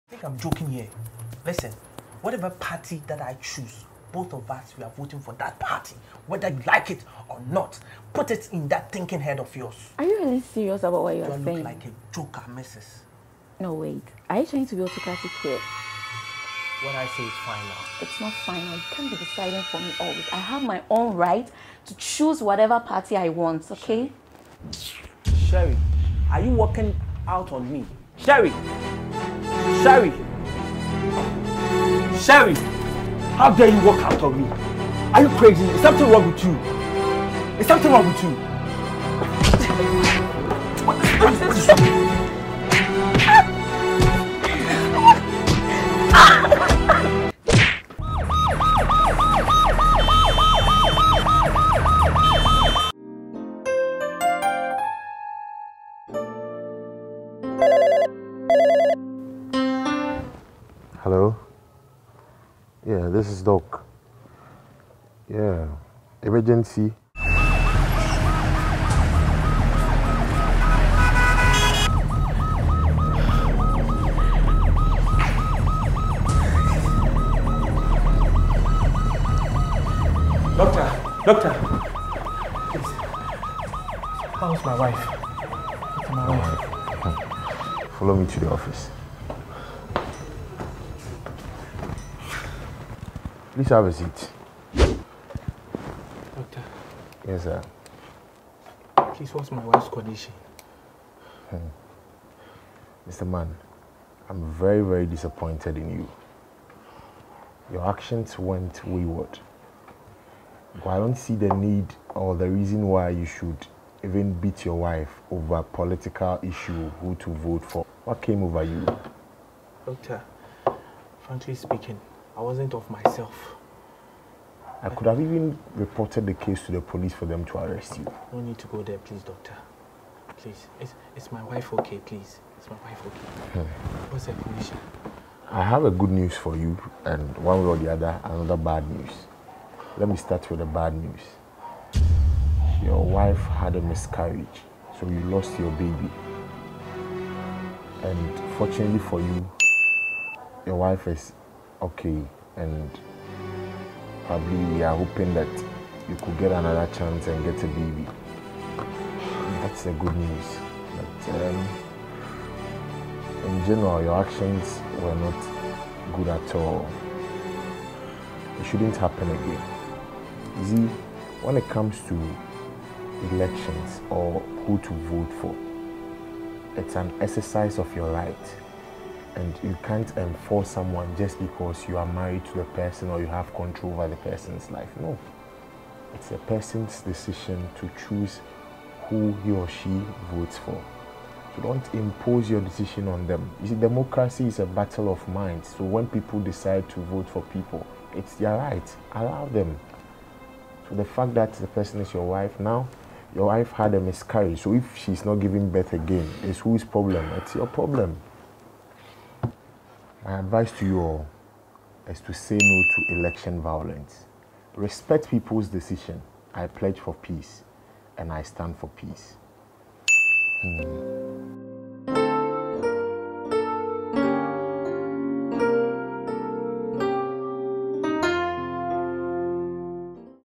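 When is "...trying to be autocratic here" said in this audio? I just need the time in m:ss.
0:14.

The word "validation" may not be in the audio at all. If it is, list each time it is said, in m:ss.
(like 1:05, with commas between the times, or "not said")
not said.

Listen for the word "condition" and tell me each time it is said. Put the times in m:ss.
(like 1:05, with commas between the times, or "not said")
1:39, 2:14.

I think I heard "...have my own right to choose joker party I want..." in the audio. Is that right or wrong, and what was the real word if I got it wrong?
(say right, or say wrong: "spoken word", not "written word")
wrong: "whatever", not "joker".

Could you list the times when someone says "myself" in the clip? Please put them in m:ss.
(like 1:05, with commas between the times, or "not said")
2:02.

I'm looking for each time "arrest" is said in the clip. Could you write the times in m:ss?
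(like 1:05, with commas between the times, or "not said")
2:07.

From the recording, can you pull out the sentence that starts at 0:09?
Are you really serious about what you are saying?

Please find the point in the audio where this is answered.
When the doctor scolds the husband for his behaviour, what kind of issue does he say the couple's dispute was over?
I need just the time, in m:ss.
1:55.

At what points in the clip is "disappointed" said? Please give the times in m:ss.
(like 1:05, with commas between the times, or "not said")
1:45.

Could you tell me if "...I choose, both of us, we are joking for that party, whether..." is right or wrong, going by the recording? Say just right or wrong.
wrong.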